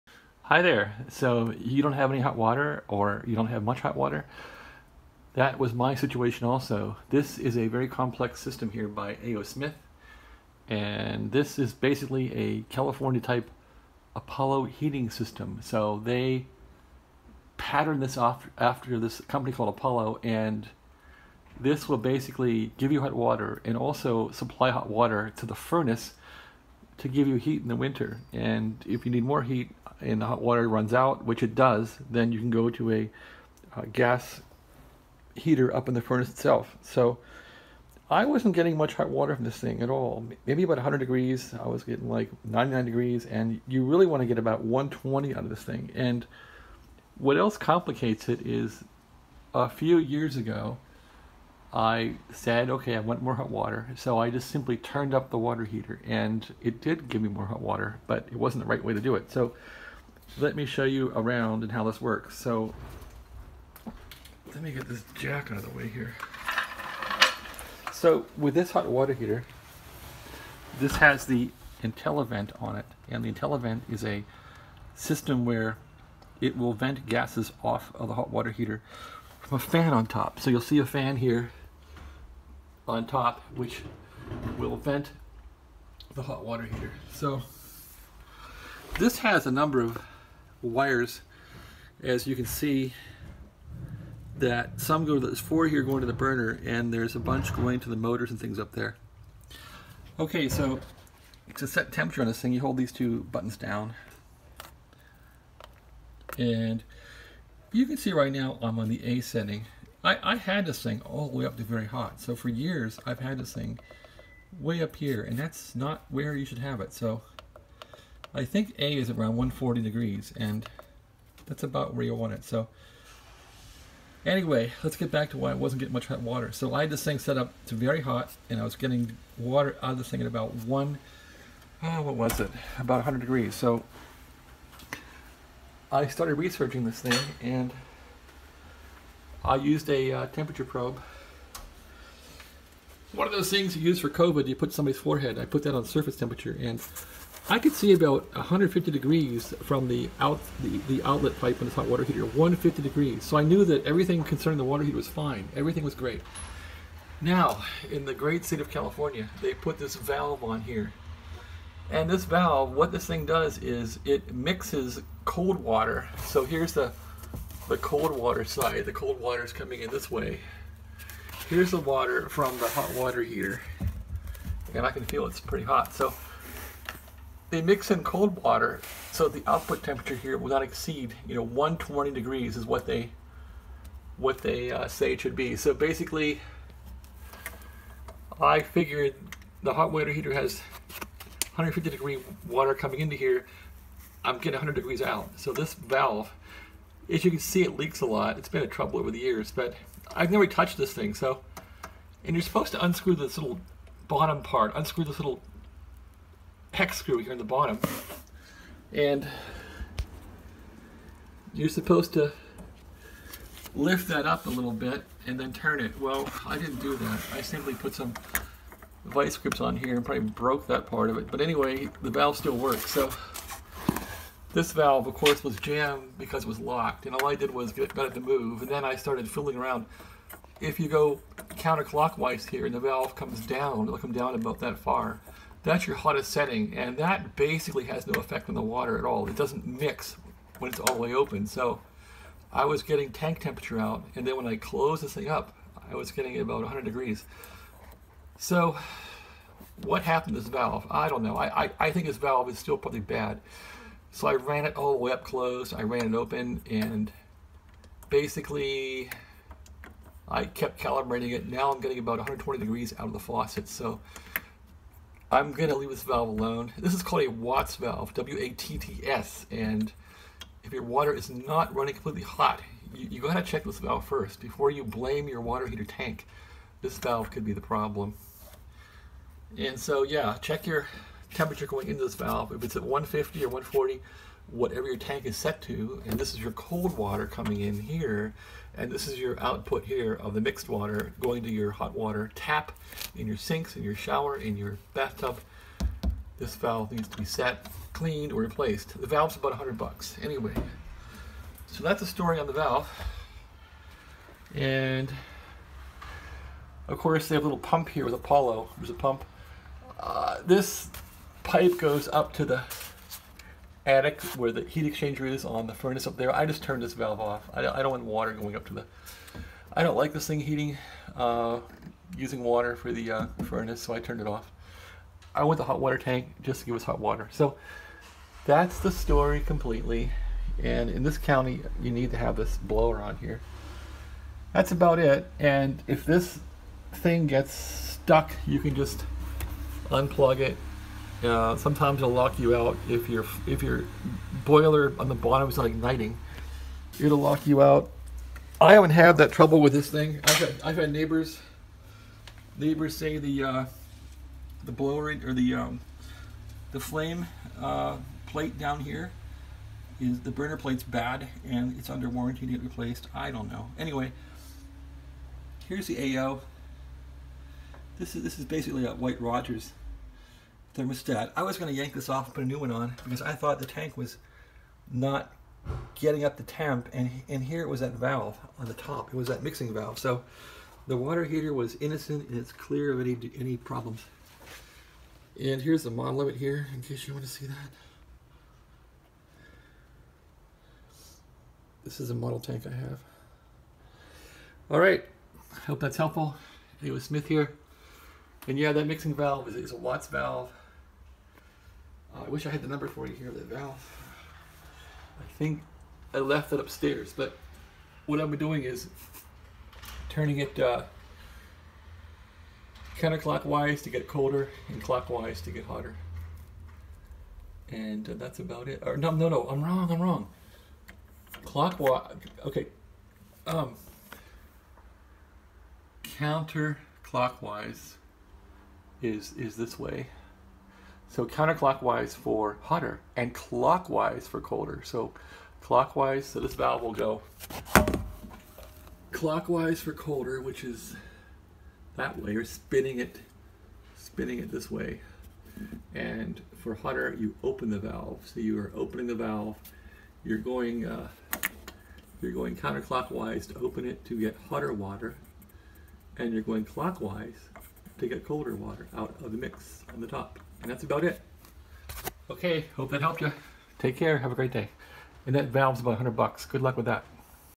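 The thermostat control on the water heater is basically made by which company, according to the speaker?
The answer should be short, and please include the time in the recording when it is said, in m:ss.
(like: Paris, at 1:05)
White Rogers, at 6:08.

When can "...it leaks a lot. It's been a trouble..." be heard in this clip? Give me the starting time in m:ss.
3:17.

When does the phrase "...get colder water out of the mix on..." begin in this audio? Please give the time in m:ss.
7:38.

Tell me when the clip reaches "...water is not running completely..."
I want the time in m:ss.
4:30.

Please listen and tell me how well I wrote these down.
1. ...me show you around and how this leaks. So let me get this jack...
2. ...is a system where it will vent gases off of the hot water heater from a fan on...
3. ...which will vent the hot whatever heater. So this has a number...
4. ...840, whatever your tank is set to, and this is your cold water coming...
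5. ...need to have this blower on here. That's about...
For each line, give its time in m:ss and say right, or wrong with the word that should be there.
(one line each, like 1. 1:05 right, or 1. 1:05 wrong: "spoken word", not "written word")
1. 1:00 wrong: "works", not "leaks"
2. 1:13 right
3. 1:23 wrong: "water", not "whatever"
4. 4:43 wrong: "140", not "840"
5. 5:31 right.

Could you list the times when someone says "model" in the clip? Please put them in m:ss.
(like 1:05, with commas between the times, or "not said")
6:25, 6:32.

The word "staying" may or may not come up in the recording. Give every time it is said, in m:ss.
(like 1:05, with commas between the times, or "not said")
not said.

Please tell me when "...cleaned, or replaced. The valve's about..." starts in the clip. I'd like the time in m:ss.
4:57.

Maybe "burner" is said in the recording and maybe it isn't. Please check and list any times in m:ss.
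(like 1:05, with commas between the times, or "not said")
1:36, 6:00.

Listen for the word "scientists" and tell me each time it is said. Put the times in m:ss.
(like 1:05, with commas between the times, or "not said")
not said.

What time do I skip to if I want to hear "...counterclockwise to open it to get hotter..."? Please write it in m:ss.
7:32.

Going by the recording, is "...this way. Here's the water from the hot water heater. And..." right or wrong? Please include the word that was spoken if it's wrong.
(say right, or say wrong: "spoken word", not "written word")
right.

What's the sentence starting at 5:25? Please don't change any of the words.
I want the hot water tank just to give us hot water.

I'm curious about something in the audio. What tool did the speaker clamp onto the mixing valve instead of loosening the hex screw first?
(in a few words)
Vice grips.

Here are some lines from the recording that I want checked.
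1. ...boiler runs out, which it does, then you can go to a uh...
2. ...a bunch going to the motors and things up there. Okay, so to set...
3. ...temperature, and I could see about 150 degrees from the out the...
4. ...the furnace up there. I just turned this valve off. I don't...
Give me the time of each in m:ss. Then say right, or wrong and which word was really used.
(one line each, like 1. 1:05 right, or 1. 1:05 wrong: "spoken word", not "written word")
1. 0:30 wrong: "water", not "boiler"
2. 1:37 right
3. 2:26 right
4. 5:15 right.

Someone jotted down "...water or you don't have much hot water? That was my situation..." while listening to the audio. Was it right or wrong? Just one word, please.
right.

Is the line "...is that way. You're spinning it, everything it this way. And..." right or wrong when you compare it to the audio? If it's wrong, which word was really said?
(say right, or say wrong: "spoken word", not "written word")
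wrong: "spinning", not "everything".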